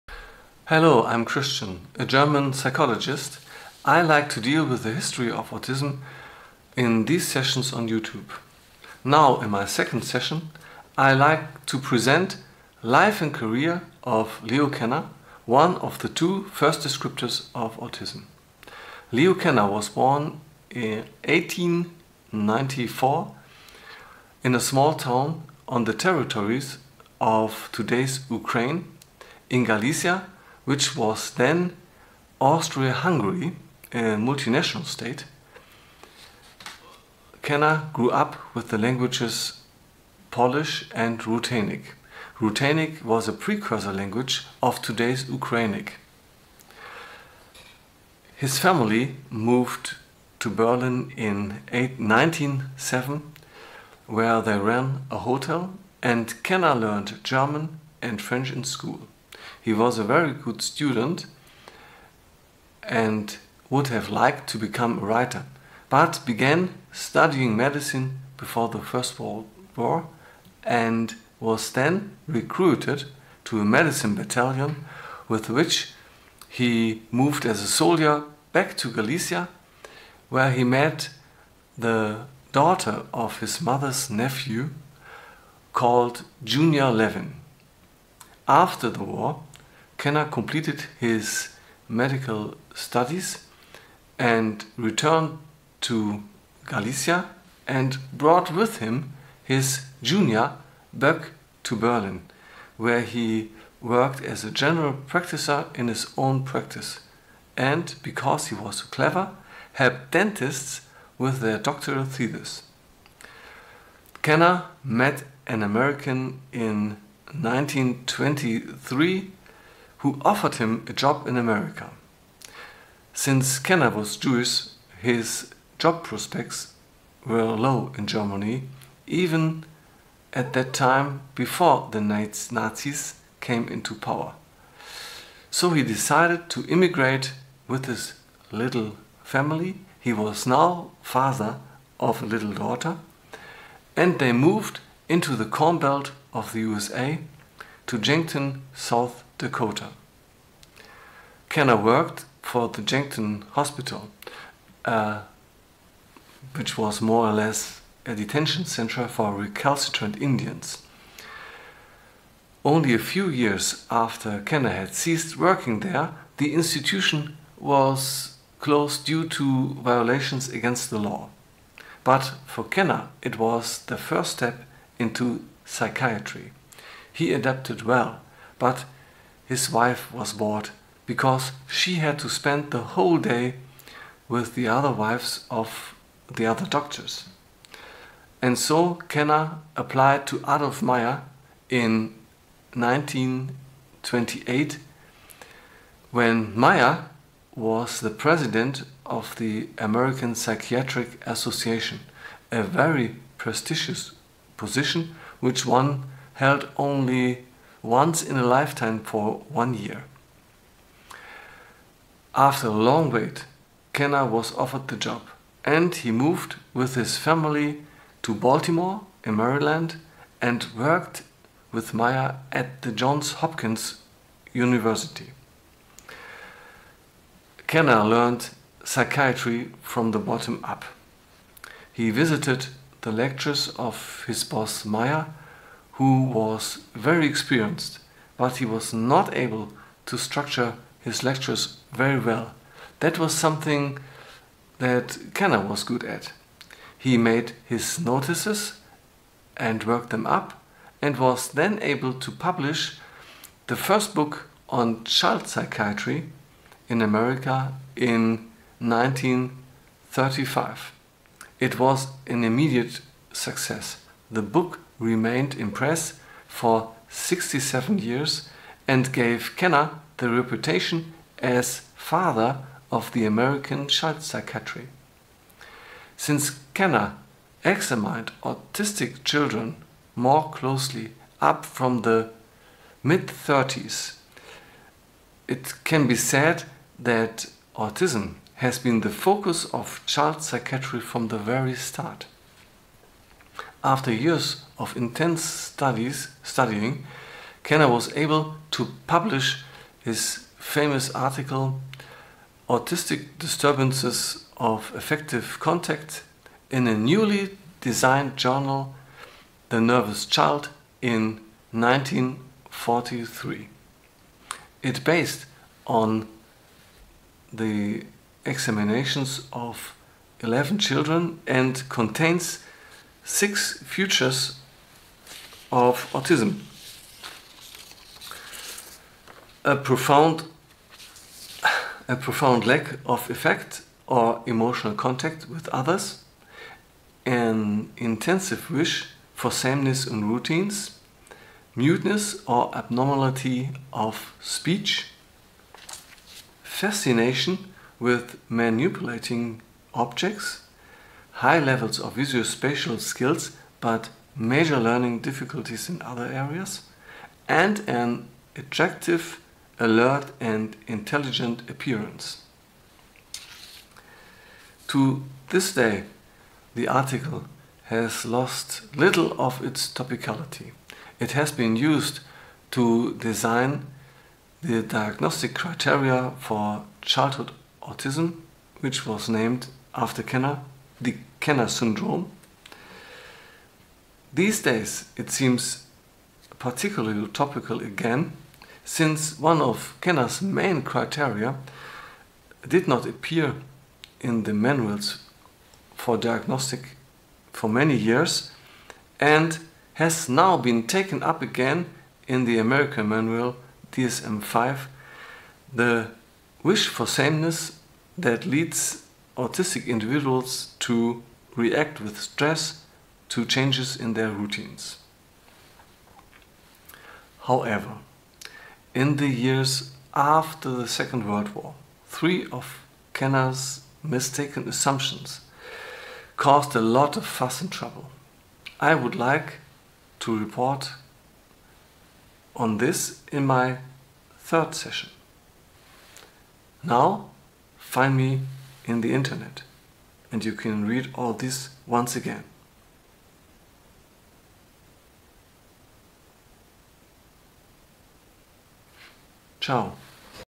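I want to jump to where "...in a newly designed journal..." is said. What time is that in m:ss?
5:06.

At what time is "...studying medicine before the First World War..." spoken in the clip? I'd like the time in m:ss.
1:06.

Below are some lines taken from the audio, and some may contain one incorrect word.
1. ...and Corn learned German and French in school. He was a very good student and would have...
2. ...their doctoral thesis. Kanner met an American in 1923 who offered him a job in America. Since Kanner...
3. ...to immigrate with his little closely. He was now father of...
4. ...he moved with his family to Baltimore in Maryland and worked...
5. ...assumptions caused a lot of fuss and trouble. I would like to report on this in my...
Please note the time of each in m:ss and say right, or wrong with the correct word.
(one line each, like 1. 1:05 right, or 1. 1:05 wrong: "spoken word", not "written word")
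1. 0:56 wrong: "Kanner", not "Corn"
2. 1:51 right
3. 2:16 wrong: "family", not "closely"
4. 3:35 right
5. 7:04 right.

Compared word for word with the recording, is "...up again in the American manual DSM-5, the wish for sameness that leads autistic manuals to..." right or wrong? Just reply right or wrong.
wrong.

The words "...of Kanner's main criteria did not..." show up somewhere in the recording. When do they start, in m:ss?
6:29.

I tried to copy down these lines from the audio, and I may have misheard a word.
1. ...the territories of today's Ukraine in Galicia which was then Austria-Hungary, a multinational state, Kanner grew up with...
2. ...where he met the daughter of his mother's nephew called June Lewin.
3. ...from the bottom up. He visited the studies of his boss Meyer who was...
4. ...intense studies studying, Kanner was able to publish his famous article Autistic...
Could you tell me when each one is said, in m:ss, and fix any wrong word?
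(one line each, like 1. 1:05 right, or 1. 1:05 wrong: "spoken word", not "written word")
1. 0:25 right
2. 1:20 right
3. 3:49 wrong: "lectures", not "studies"
4. 4:54 right.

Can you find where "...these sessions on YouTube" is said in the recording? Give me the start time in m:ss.
0:07.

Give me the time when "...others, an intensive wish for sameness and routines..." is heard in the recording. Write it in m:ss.
5:35.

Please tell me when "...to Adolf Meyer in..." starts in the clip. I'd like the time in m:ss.
3:10.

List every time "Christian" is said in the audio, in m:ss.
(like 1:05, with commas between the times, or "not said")
0:01.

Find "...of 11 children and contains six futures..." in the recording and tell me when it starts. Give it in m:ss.
5:19.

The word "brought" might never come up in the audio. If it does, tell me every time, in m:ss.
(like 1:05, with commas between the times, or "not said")
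1:38.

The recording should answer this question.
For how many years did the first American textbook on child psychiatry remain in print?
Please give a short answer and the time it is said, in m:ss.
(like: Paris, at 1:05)
67, at 4:27.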